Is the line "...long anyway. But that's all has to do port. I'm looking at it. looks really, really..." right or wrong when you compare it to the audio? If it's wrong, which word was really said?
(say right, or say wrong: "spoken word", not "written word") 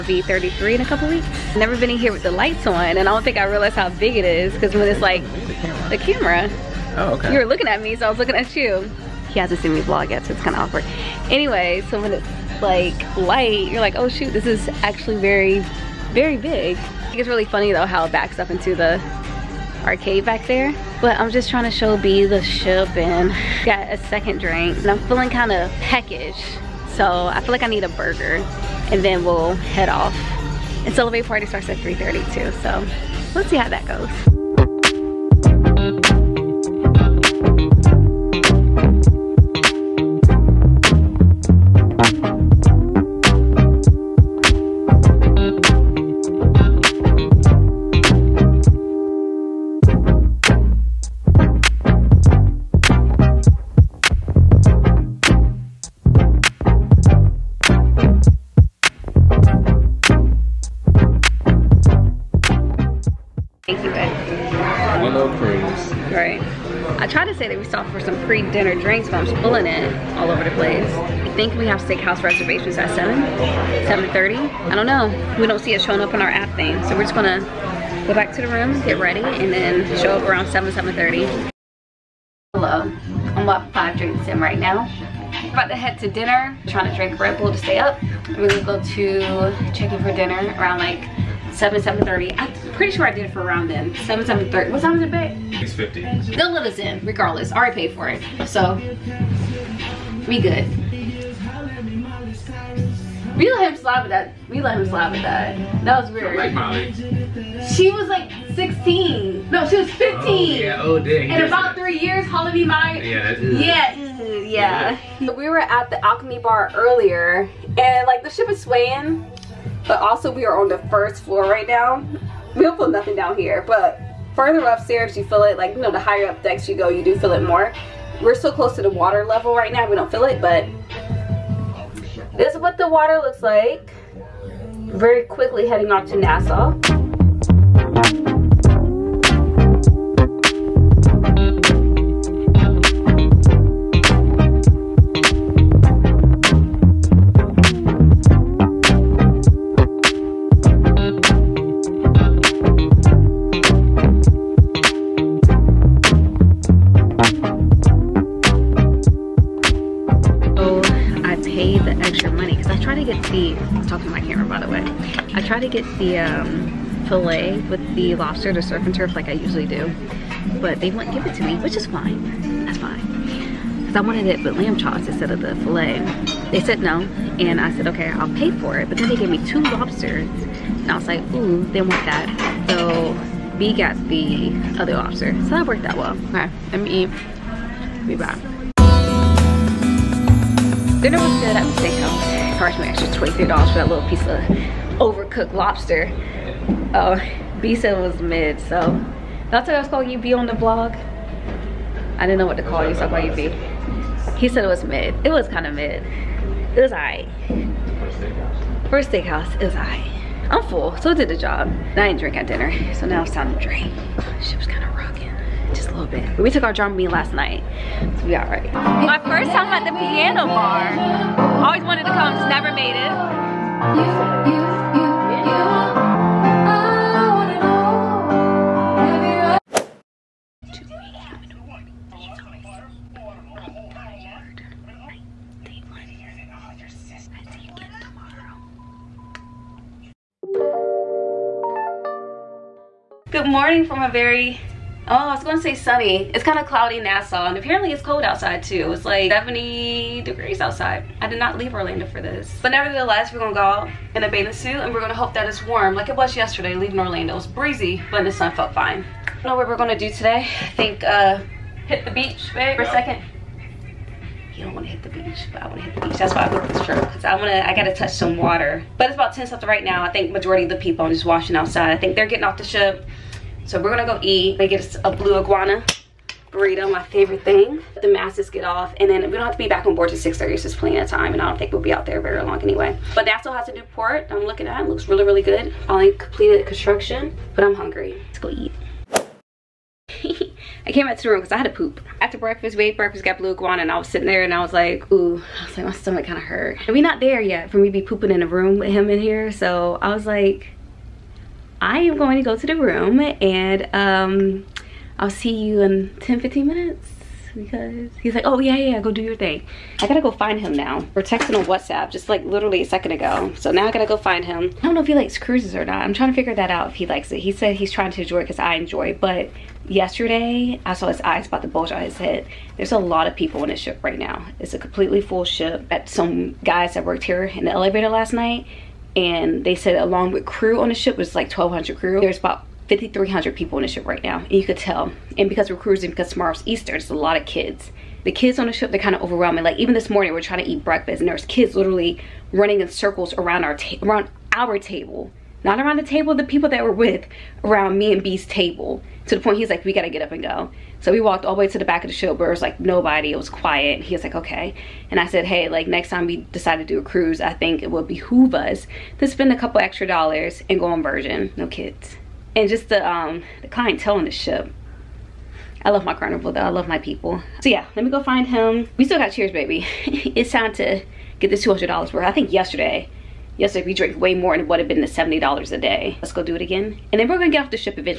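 right.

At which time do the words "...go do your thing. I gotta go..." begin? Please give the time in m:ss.
5:08.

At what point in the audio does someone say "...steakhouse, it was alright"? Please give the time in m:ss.
3:29.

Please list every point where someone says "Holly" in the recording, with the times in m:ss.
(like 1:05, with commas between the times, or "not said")
1:52.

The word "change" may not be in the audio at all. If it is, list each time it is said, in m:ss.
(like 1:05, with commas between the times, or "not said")
not said.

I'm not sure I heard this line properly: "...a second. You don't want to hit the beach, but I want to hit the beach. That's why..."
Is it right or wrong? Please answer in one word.
right.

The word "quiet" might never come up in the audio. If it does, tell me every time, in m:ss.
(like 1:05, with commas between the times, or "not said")
5:53.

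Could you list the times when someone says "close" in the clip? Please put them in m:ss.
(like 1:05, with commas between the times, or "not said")
2:08.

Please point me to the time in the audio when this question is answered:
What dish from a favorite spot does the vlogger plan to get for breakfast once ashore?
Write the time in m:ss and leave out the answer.
4:35.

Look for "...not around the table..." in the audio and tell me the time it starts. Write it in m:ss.
5:45.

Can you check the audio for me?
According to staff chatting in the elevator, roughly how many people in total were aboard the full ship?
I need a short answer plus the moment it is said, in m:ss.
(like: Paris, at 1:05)
5300, at 5:32.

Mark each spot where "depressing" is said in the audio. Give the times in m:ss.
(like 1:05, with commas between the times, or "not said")
not said.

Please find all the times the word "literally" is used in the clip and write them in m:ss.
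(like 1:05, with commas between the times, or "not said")
5:12, 5:41.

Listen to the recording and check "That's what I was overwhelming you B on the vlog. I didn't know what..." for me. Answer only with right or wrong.
wrong.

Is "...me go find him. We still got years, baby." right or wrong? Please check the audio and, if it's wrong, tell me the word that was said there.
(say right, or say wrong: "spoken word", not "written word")
wrong: "cheers", not "years".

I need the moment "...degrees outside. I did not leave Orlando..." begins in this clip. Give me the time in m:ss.
4:10.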